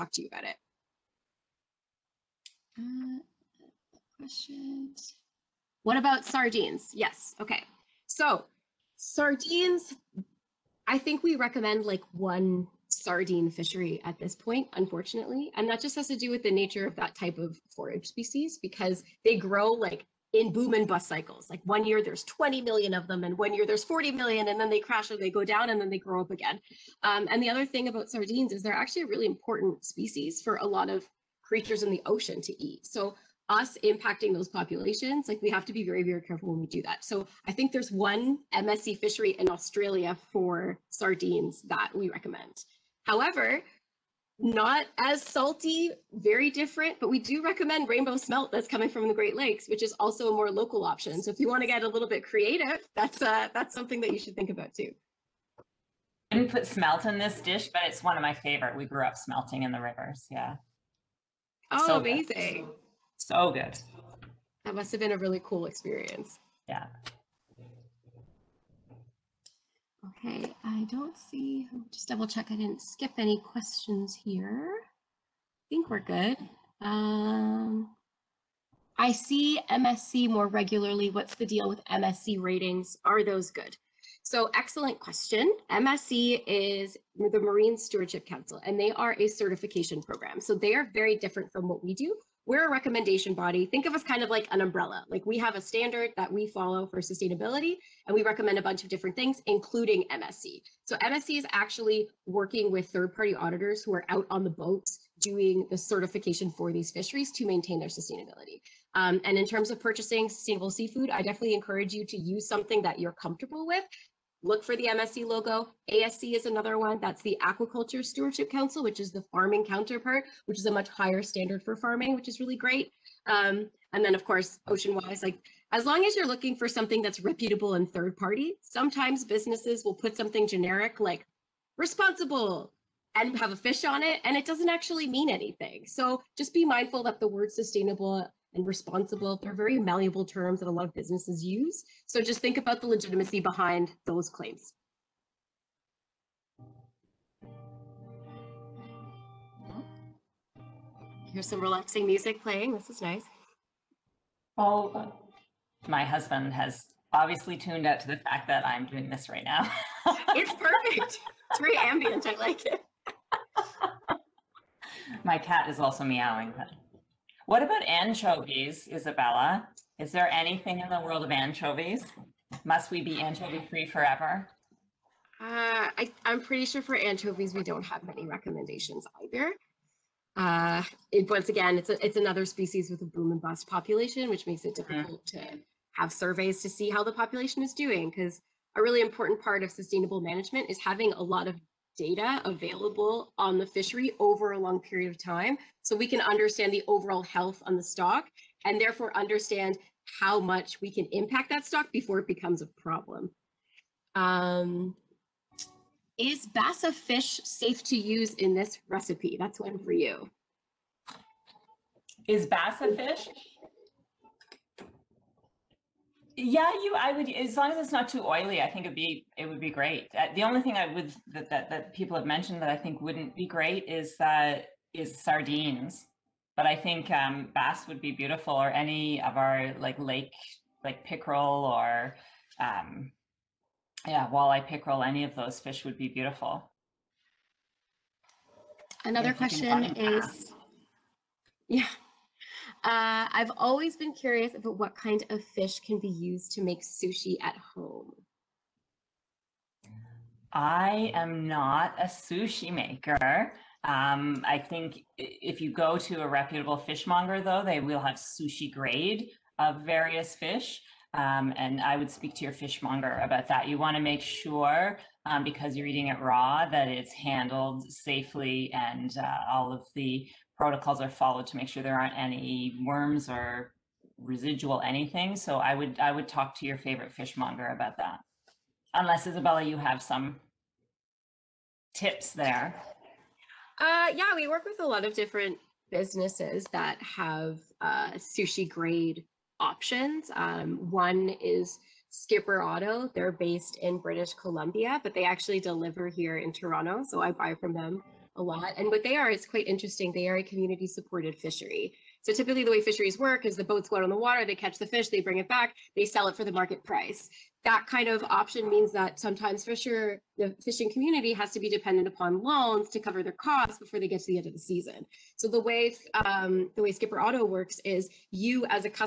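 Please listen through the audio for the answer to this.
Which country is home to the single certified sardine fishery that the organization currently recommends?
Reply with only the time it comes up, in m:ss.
0:39.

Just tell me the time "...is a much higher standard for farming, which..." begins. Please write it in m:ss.
2:00.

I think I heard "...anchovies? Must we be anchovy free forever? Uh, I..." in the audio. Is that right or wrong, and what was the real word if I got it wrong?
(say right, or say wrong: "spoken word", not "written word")
right.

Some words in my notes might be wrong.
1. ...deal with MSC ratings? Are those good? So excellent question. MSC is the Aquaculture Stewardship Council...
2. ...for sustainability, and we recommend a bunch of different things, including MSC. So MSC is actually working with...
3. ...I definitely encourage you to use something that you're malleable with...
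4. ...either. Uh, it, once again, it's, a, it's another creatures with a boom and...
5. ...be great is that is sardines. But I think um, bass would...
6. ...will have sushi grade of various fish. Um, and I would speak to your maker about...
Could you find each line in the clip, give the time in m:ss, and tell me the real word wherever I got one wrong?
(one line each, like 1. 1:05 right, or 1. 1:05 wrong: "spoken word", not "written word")
1. 1:21 wrong: "Marine", not "Aquaculture"
2. 1:36 right
3. 1:51 wrong: "comfortable", not "malleable"
4. 2:59 wrong: "species", not "creatures"
5. 3:43 right
6. 4:17 wrong: "fishmonger", not "maker".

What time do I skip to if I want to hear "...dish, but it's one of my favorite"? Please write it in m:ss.
0:57.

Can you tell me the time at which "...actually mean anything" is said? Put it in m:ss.
2:14.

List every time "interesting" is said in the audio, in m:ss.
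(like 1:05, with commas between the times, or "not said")
4:59.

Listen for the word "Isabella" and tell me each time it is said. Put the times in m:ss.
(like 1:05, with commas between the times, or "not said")
2:48, 4:39.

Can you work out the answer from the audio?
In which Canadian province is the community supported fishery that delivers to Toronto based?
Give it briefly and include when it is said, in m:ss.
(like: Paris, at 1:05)
British Columbia, at 4:53.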